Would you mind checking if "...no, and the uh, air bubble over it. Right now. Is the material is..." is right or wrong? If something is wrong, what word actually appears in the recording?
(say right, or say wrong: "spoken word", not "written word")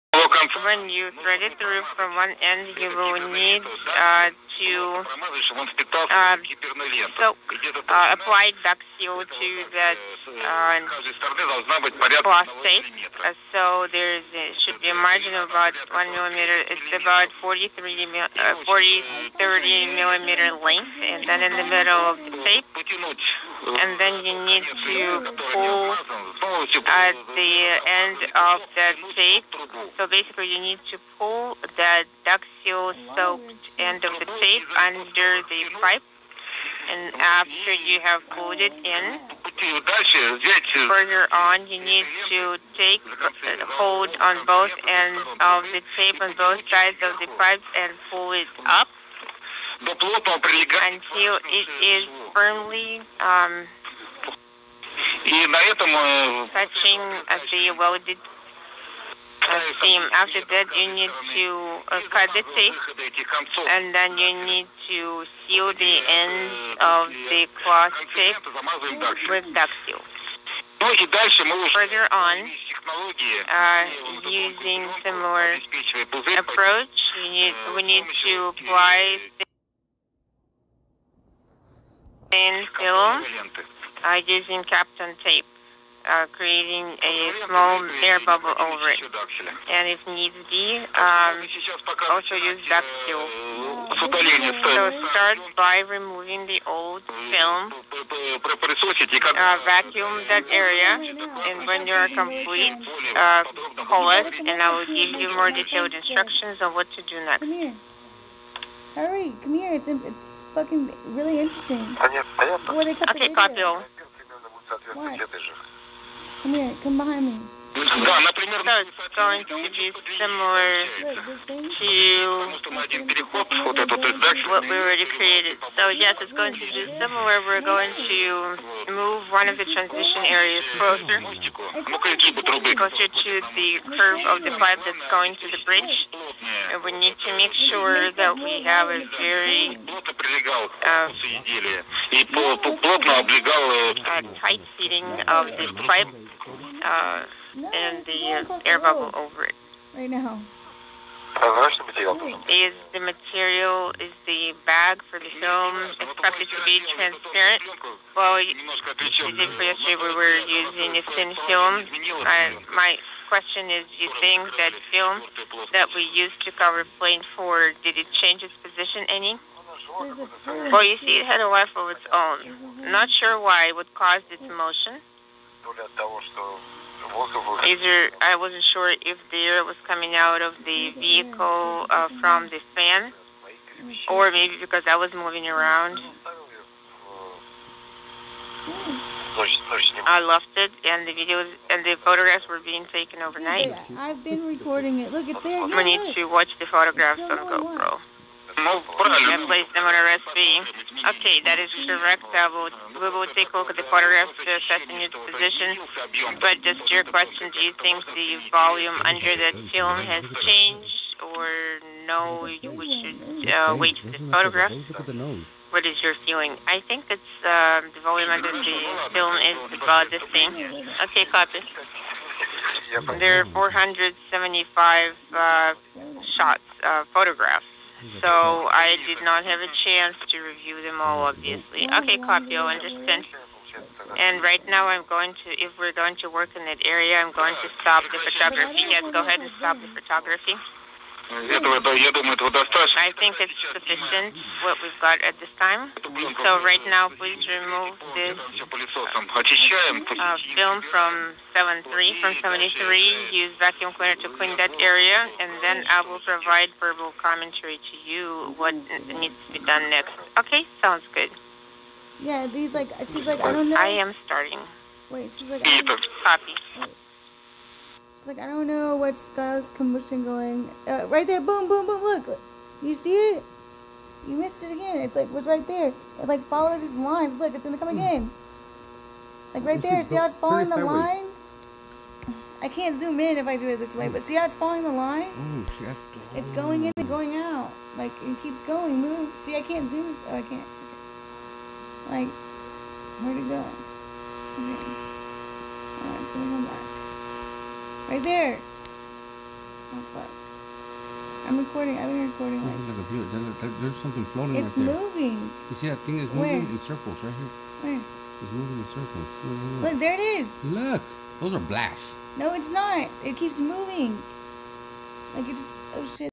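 right.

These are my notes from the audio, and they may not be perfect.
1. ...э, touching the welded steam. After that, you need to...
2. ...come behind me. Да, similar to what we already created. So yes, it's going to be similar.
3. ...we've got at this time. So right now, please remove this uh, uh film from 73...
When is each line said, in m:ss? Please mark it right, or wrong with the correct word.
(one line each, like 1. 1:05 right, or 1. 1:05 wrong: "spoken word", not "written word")
1. 0:55 right
2. 1:56 right
3. 4:04 right.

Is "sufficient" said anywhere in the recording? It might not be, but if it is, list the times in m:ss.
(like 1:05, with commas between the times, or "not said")
4:03.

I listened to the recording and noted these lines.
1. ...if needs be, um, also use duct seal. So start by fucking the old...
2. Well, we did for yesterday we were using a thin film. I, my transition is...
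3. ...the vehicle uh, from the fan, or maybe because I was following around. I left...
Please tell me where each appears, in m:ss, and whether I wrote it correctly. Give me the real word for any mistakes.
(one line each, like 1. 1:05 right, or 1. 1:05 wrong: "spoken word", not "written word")
1. 1:29 wrong: "removing", not "fucking"
2. 2:38 wrong: "question", not "transition"
3. 3:00 wrong: "moving", not "following".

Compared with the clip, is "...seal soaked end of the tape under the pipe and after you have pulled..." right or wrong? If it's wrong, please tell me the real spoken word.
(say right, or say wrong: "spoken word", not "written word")
right.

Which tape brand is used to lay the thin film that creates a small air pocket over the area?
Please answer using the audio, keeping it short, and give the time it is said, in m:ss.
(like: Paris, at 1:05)
Kapton, at 1:24.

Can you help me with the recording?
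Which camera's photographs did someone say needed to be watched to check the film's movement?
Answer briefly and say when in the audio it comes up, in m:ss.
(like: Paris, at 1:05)
GoPro, at 3:17.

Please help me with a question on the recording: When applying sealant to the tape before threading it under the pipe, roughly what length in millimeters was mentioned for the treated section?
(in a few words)
30 millimeters.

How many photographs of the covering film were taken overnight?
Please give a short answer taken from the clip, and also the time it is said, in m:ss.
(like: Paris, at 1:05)
475, at 3:43.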